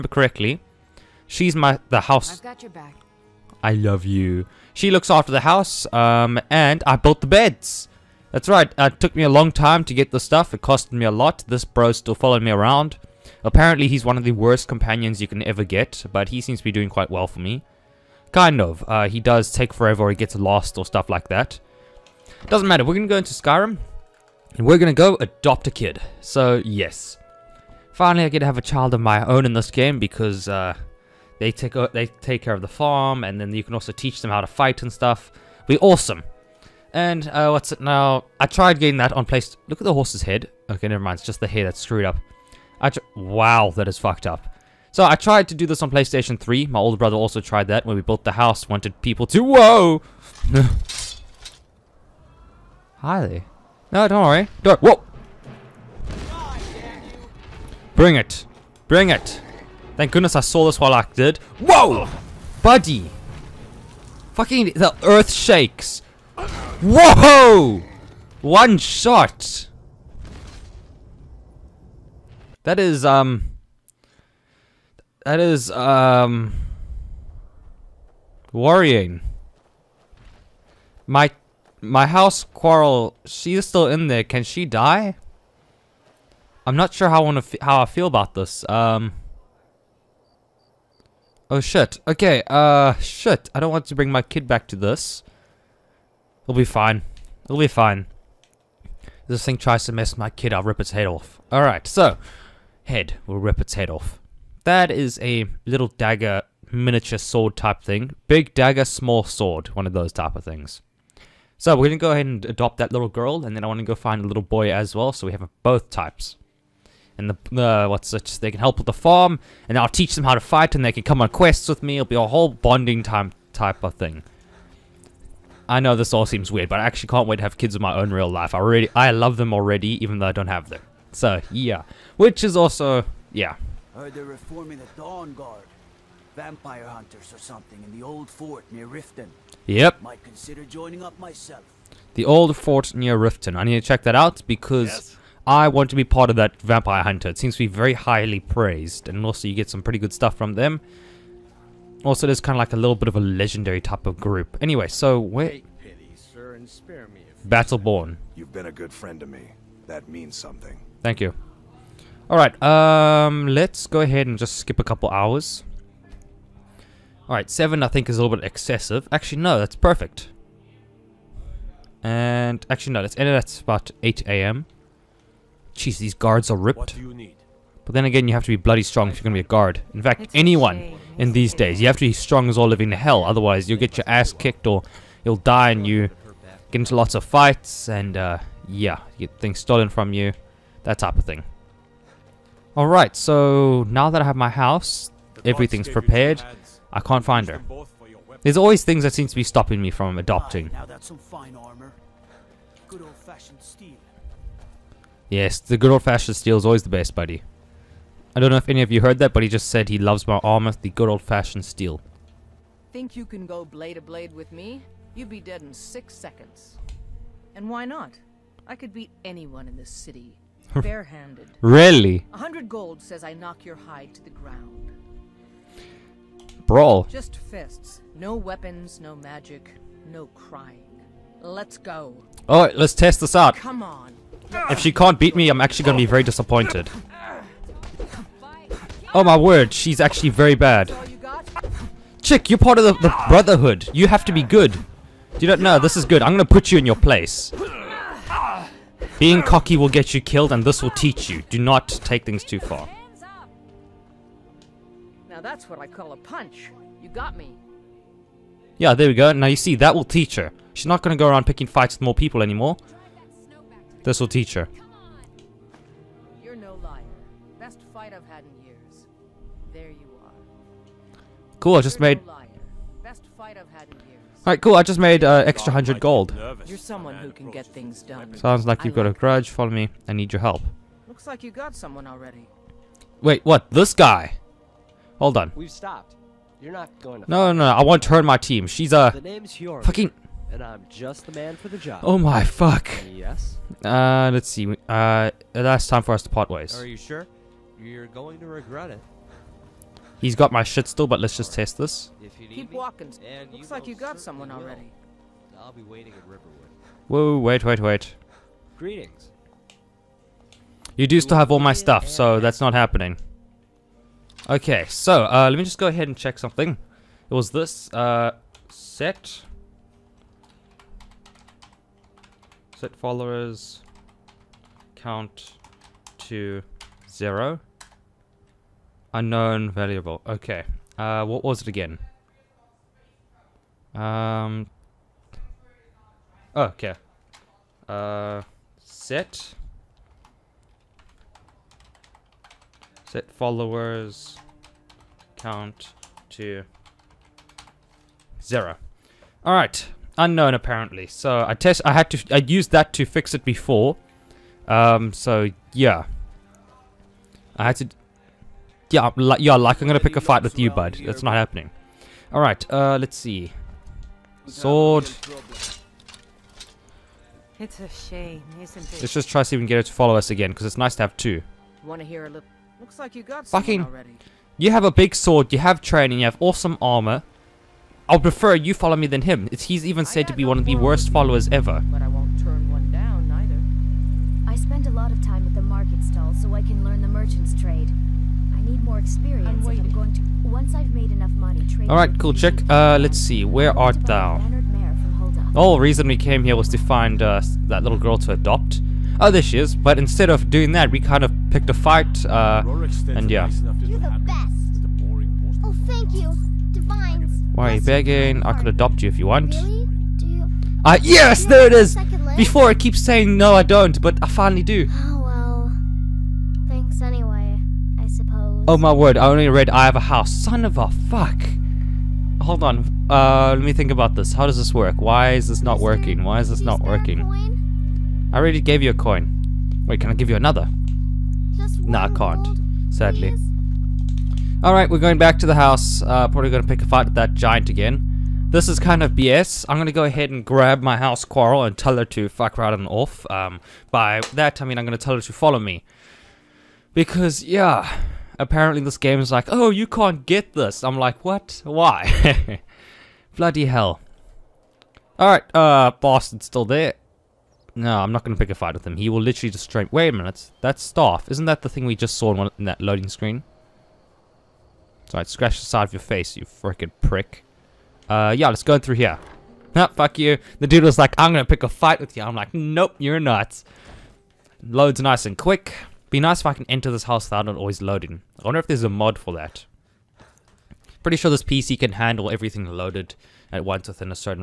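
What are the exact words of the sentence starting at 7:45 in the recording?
Sorry, scratch the side of your face, you freaking prick.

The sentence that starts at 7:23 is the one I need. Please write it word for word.
Um, by that, I mean I'm going to tell her to follow me.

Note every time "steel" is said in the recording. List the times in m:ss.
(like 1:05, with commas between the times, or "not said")
3:26, 3:31.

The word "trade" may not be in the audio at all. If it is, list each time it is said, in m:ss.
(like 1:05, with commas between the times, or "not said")
6:27, 6:31.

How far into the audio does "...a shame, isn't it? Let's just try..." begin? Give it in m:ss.
6:07.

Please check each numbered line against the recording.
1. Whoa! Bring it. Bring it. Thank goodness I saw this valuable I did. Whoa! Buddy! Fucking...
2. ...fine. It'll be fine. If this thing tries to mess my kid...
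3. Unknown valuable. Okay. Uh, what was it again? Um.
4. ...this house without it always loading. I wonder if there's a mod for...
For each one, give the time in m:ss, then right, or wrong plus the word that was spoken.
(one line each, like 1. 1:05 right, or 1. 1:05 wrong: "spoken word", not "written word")
1. 0:54 wrong: "while", not "valuable"
2. 1:36 right
3. 5:29 right
4. 7:56 right.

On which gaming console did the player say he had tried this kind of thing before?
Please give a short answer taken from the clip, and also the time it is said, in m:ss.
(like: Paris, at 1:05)
PlayStation 3, at 0:45.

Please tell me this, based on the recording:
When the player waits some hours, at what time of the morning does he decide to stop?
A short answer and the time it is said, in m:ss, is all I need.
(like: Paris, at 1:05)
8am, at 2:54.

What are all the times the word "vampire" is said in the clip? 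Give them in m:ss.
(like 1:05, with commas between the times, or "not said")
2:16, 2:26.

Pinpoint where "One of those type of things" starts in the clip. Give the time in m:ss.
1:49.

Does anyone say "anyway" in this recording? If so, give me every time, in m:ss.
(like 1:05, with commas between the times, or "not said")
2:34, 6:57.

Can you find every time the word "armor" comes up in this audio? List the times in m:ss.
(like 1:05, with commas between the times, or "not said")
3:30, 6:16.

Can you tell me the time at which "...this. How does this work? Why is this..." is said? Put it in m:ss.
7:04.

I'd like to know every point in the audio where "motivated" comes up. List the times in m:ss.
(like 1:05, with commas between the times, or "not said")
not said.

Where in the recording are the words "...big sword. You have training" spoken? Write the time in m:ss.
6:14.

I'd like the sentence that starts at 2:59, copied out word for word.
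In fact, it's anyone in these days.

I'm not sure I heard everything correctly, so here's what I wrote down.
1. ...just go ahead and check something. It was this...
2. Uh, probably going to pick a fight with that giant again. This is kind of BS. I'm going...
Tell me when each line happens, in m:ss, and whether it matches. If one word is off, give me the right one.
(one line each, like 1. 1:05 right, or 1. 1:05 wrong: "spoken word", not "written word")
1. 5:15 right
2. 7:15 right.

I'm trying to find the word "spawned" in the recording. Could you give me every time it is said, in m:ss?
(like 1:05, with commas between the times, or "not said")
not said.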